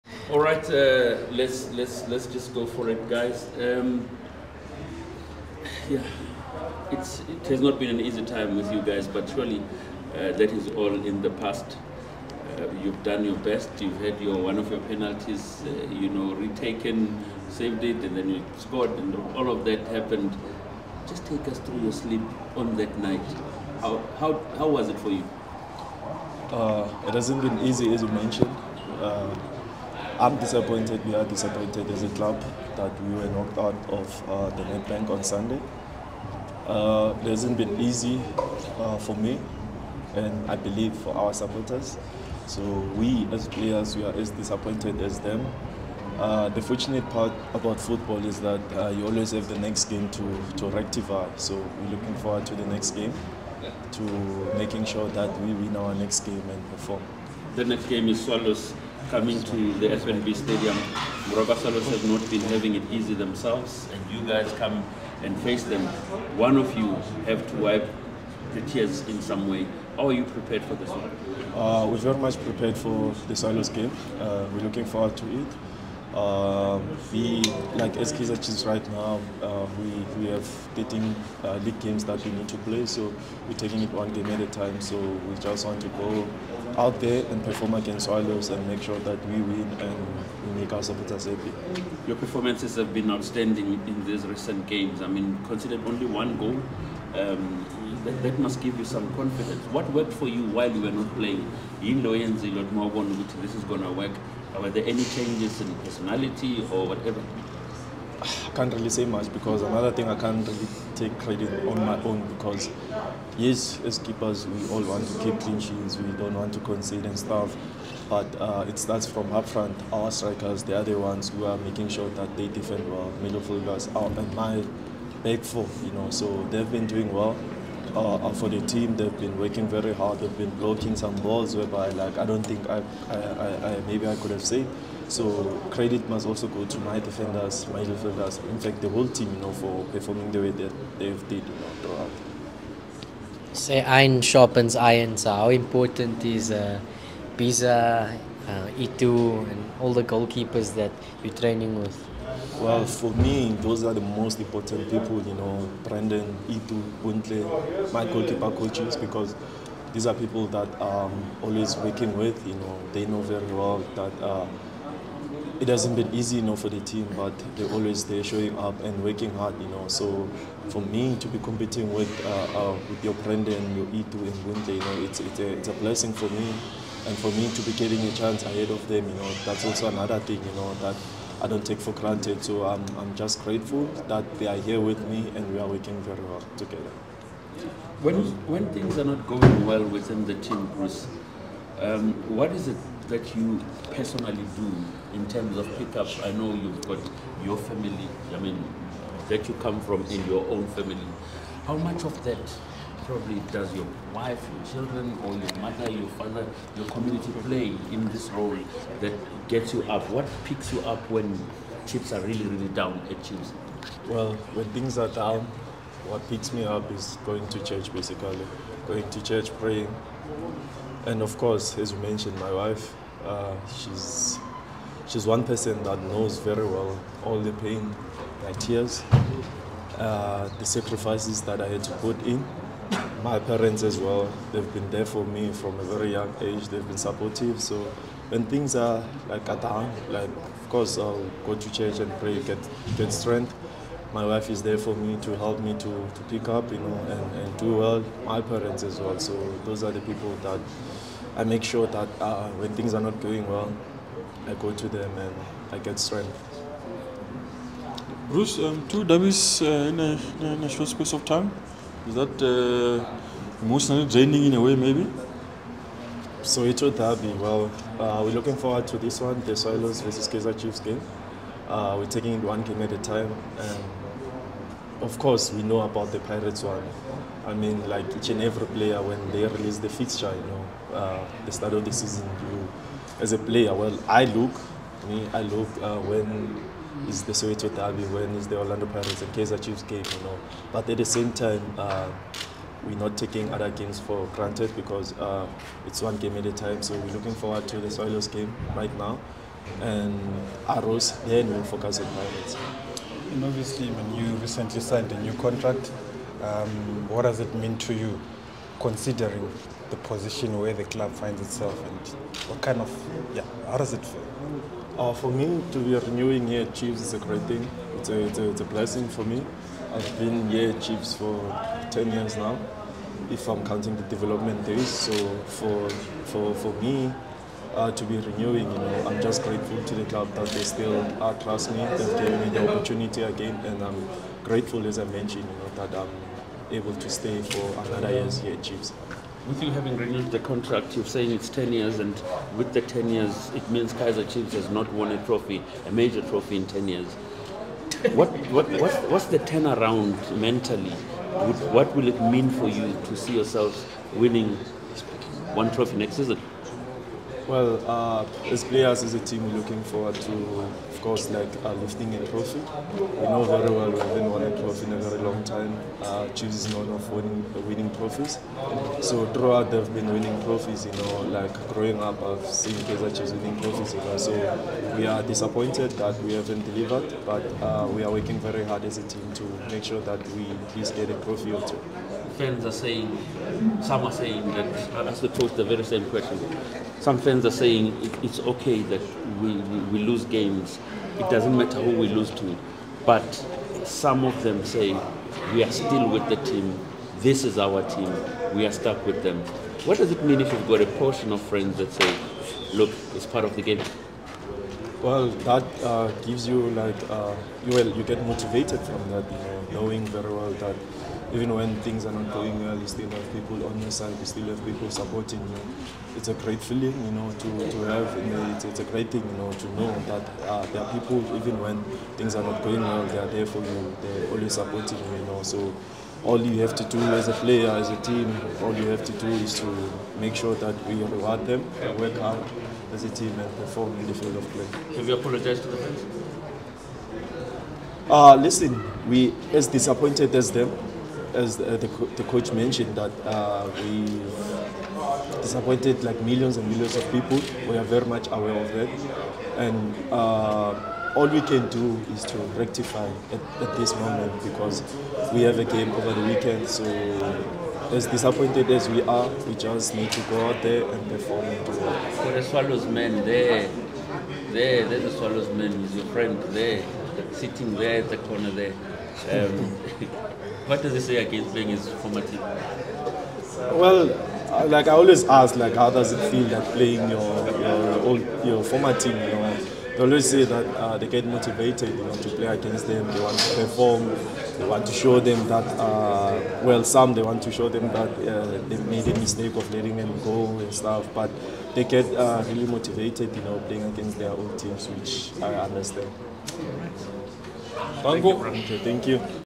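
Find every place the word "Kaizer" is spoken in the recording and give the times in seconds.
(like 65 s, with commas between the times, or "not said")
77 s, 270 s, 289 s, 343 s, 372 s.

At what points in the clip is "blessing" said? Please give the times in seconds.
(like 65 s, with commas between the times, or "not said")
175 s, 318 s.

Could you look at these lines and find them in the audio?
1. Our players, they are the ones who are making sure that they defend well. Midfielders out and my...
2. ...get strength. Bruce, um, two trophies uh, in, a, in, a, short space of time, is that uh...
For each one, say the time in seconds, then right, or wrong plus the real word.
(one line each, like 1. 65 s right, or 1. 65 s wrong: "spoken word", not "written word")
1. 119 s wrong: "strikers", not "players"
2. 255 s wrong: "derbies", not "trophies".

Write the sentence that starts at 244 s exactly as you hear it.
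My wife is there for me to help me to, to pick up, you know, and, and do well.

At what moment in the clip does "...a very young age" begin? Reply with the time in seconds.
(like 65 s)
235 s.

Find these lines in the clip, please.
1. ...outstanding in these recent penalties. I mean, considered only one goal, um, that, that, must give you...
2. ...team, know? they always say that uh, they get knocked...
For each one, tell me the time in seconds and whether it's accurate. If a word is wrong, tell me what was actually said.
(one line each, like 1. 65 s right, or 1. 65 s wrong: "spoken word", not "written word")
1. 93 s wrong: "games", not "penalties"
2. 478 s wrong: "motivated", not "knocked".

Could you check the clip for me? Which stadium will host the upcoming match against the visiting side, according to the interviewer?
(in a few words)
FNB Stadium.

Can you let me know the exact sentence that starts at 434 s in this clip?
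Have you apologized to the fans?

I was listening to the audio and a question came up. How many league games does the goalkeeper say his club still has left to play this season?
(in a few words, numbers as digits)
13.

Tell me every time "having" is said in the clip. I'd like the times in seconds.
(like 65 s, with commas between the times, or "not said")
62 s, 339 s.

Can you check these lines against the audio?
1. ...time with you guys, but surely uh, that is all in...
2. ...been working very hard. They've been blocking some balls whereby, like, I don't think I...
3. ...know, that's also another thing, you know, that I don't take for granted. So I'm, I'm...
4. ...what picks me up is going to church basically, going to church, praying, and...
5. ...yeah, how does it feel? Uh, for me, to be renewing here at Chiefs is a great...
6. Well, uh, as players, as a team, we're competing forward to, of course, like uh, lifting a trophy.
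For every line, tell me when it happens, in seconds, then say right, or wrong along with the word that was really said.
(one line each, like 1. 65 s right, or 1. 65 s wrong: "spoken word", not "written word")
1. 8 s right
2. 129 s right
3. 179 s right
4. 216 s right
5. 313 s right
6. 357 s wrong: "looking", not "competing".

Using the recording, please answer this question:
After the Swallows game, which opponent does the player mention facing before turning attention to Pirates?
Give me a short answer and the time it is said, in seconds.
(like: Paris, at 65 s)
Arrows, at 300 s.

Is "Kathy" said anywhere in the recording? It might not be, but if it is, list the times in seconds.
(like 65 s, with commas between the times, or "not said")
not said.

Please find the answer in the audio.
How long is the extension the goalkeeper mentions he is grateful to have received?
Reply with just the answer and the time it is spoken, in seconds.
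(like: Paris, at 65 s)
another year, at 337 s.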